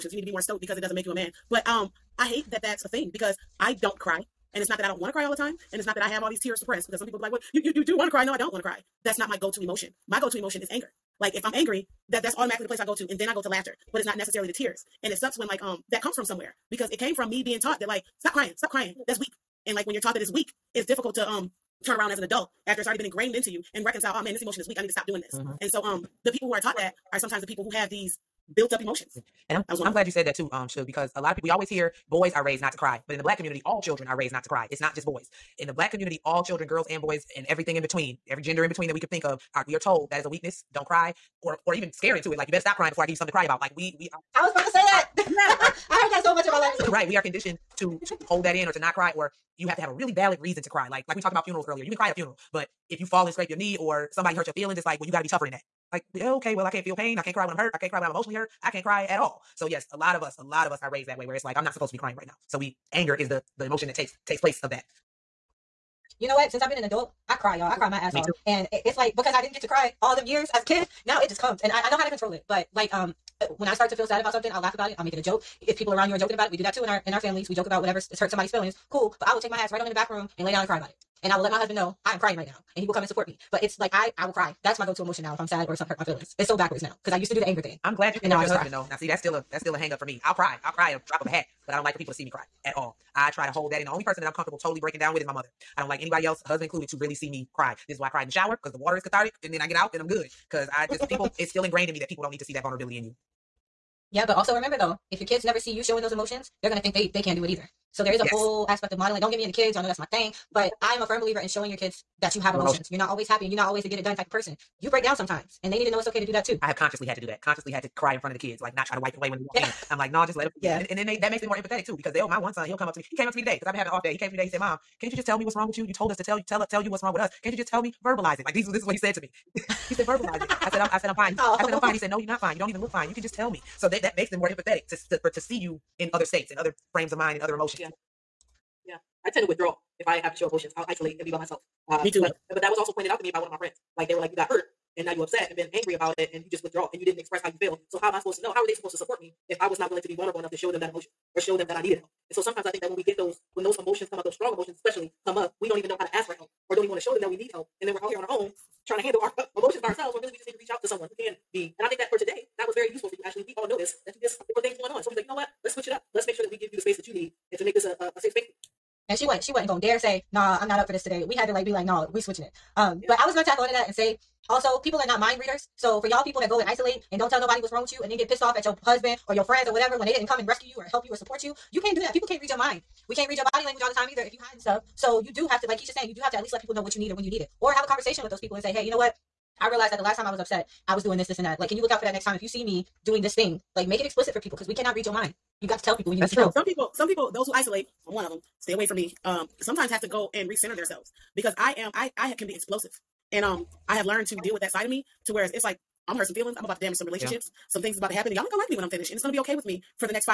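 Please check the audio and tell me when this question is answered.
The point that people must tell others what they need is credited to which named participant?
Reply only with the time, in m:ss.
3:05.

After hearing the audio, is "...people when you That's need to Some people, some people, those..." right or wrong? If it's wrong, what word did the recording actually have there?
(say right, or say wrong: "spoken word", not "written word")
right.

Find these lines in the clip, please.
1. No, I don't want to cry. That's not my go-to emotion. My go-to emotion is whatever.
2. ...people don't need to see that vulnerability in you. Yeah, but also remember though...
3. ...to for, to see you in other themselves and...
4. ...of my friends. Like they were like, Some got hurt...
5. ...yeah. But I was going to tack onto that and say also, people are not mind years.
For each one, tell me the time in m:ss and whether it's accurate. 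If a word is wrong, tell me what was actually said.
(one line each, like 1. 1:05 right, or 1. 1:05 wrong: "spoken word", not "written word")
1. 0:08 wrong: "anger", not "whatever"
2. 1:42 right
3. 2:15 wrong: "states", not "themselves"
4. 2:23 wrong: "You", not "Some"
5. 2:53 wrong: "readers", not "years".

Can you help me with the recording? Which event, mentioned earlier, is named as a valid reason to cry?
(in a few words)
funerals.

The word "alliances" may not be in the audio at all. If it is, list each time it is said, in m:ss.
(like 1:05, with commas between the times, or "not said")
not said.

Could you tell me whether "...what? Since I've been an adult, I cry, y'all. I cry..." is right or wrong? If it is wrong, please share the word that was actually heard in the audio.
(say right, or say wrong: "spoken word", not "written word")
right.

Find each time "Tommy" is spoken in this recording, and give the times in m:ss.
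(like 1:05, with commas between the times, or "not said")
not said.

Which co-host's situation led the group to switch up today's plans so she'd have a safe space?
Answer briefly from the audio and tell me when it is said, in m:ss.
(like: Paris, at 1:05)
Ashley, at 2:43.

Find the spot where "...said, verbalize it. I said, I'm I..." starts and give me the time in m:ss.
2:09.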